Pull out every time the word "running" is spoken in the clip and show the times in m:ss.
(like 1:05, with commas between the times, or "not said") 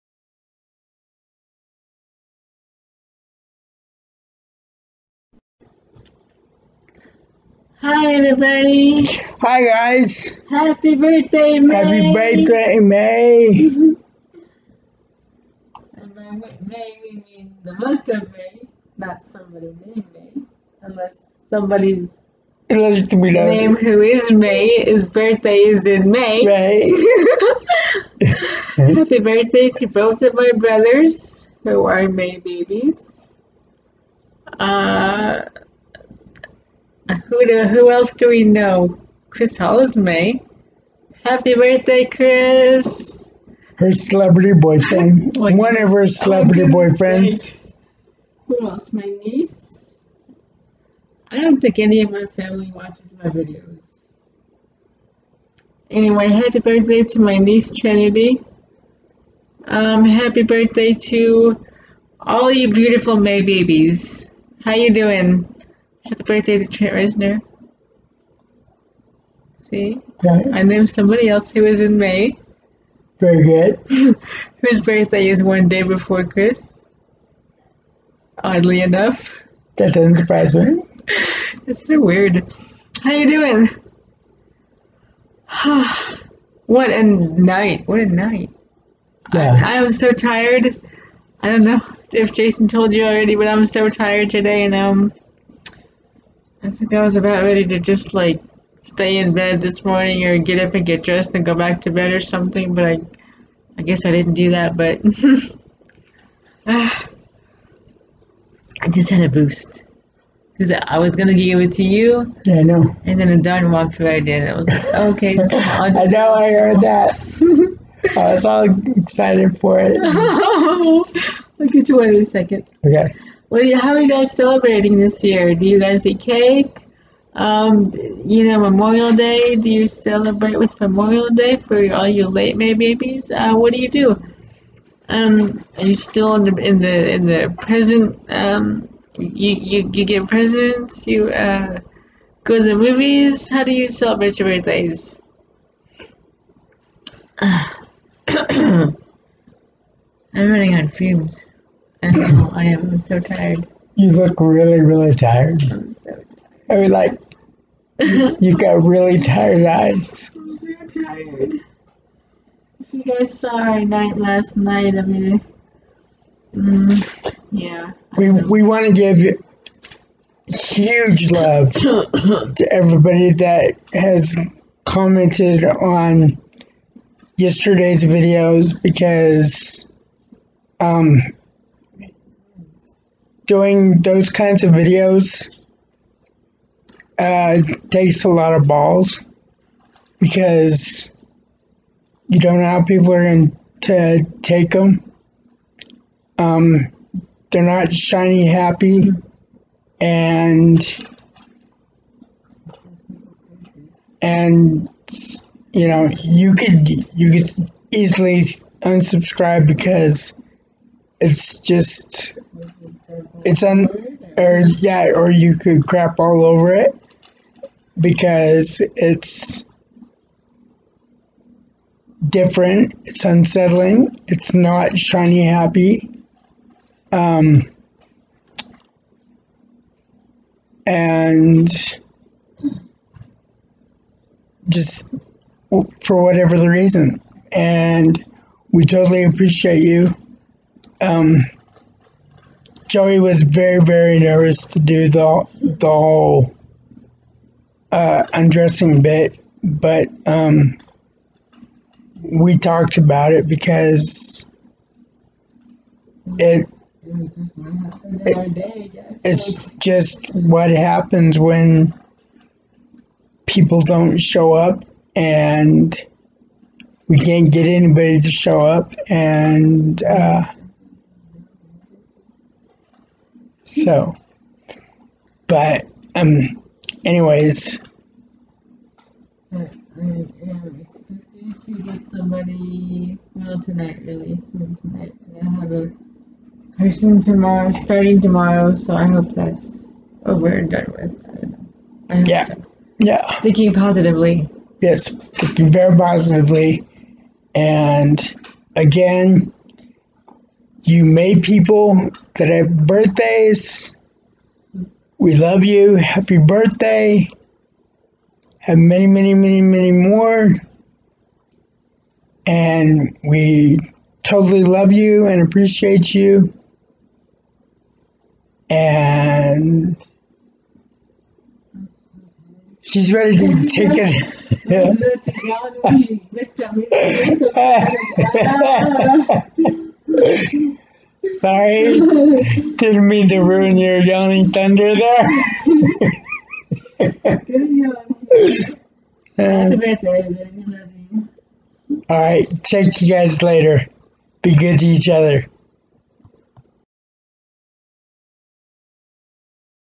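2:30.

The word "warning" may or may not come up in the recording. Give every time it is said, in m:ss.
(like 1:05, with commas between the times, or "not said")
not said.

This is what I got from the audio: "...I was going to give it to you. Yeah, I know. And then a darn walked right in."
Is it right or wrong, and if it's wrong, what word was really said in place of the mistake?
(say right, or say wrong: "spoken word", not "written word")
right.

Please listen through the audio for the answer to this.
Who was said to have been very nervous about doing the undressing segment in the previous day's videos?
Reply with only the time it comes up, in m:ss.
4:02.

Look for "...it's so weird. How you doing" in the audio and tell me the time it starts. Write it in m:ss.
1:21.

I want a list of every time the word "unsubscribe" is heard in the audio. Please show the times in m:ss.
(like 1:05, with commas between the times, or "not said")
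3:28.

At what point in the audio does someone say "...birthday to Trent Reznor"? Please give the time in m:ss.
1:06.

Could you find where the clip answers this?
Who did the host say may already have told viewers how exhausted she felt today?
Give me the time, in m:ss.
1:32.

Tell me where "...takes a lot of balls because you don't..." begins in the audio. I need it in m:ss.
3:07.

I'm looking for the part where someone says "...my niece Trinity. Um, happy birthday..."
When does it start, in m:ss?
0:57.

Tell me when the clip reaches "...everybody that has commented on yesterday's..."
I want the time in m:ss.
2:52.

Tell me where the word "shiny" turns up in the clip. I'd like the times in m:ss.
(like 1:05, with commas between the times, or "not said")
3:17, 3:44.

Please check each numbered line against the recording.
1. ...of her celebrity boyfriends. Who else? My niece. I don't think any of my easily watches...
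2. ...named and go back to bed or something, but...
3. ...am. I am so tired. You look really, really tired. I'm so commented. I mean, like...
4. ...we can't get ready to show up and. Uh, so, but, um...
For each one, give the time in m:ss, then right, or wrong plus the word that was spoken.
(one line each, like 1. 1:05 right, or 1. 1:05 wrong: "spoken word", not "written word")
1. 0:45 wrong: "family", not "easily"
2. 1:41 wrong: "dressed", not "named"
3. 2:32 wrong: "tired", not "commented"
4. 4:27 wrong: "anybody", not "ready".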